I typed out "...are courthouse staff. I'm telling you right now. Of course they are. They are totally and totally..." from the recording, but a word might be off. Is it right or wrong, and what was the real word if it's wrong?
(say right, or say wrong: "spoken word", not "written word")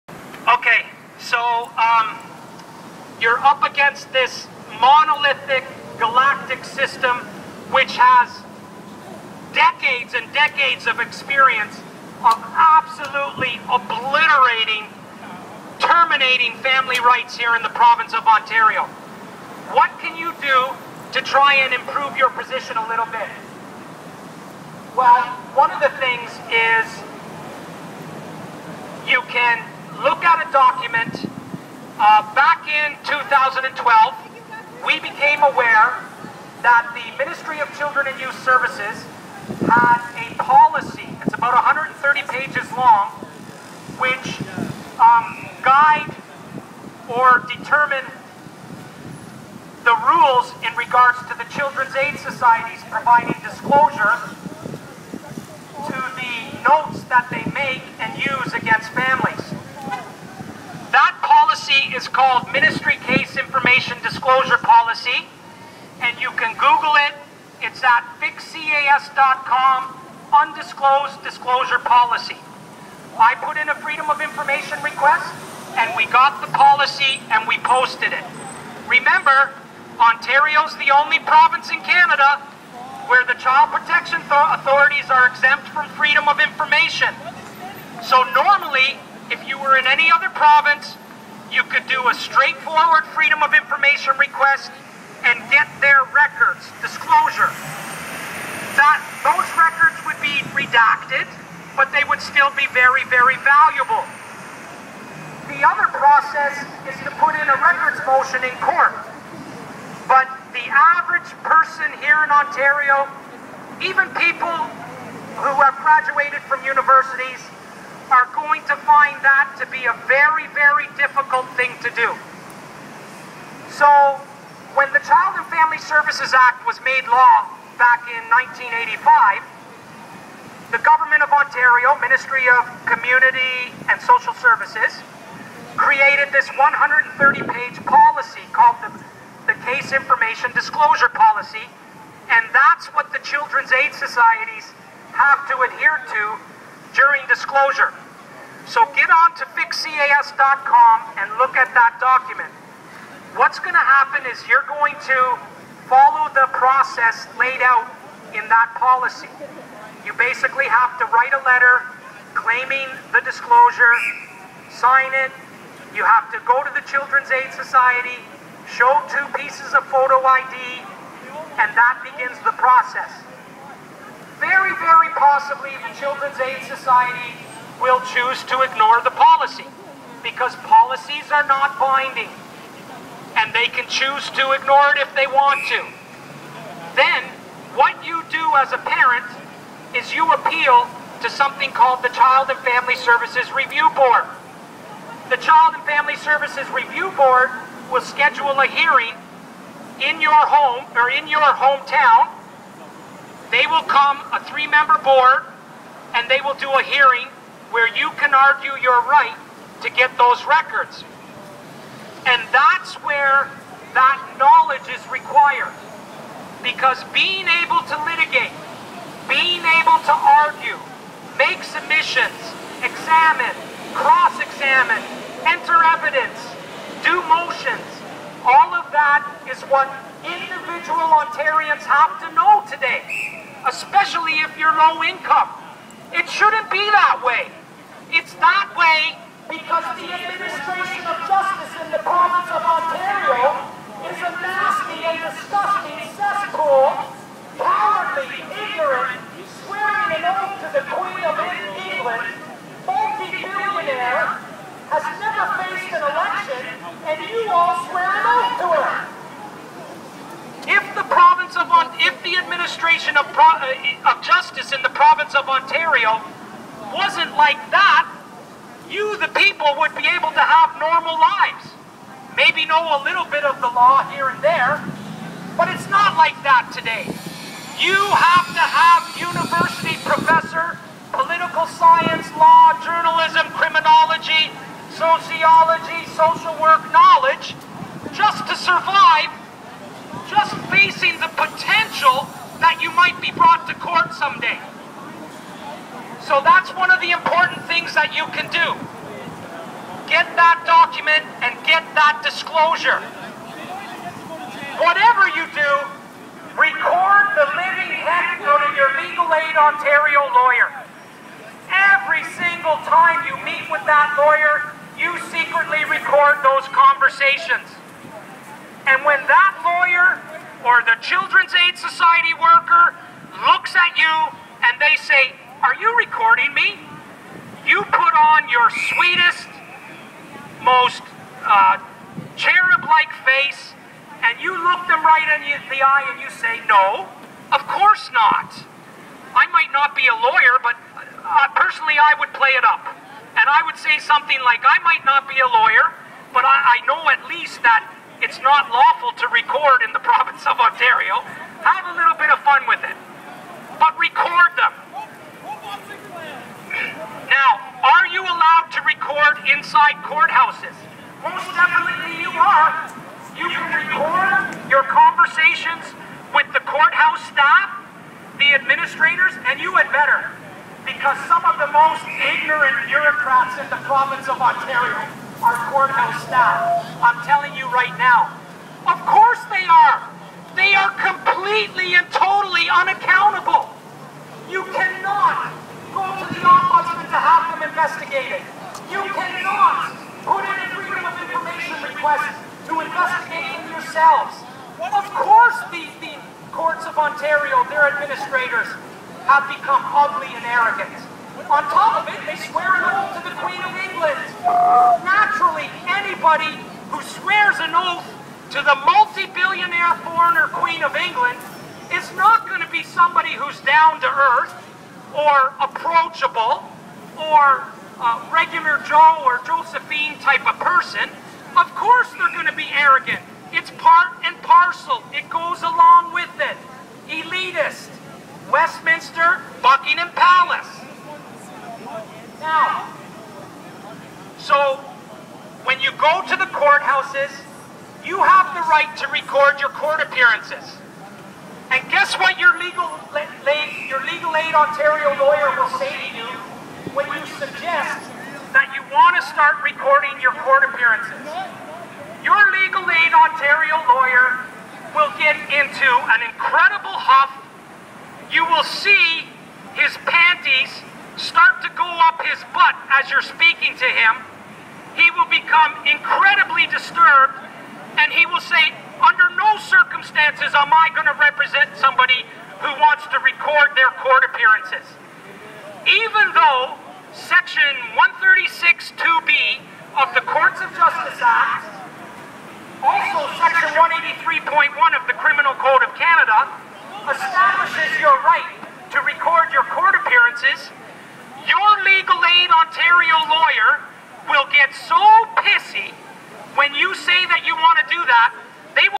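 wrong: "completely", not "totally".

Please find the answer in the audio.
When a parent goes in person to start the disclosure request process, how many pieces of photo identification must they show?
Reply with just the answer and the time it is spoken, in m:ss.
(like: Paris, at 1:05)
2, at 2:49.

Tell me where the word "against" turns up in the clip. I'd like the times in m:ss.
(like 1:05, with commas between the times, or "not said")
0:03, 0:58.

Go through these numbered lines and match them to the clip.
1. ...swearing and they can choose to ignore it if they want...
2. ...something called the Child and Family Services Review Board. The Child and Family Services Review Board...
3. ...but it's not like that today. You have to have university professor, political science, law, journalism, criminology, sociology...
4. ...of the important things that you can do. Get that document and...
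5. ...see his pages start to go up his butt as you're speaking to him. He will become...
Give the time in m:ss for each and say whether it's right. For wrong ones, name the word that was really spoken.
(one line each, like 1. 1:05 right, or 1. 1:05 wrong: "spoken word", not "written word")
1. 3:01 wrong: "binding", not "swearing"
2. 3:11 right
3. 4:35 right
4. 4:56 right
5. 7:38 wrong: "panties", not "pages".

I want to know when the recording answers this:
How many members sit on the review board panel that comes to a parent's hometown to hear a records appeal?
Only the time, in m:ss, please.
3:24.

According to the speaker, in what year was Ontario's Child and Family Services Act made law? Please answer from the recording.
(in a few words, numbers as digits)
1985.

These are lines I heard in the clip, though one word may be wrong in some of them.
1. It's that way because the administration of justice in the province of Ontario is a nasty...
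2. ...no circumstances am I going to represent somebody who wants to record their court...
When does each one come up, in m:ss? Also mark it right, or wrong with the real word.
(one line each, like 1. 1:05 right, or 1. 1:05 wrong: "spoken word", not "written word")
1. 3:58 right
2. 7:49 right.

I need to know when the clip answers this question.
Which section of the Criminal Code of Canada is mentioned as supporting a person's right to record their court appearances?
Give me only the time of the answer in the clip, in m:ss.
8:03.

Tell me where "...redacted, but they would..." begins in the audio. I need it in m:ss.
1:40.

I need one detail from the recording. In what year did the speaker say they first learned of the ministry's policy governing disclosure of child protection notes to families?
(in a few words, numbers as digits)
2012.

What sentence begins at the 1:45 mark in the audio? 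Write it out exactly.
The other process is to put in a records motion in court.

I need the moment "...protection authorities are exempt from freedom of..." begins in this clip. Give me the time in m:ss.
1:23.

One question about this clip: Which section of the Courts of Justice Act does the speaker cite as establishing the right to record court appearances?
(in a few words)
136.2b.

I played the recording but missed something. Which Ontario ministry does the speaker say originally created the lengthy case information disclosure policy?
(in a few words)
Ministry of Community and Social Services.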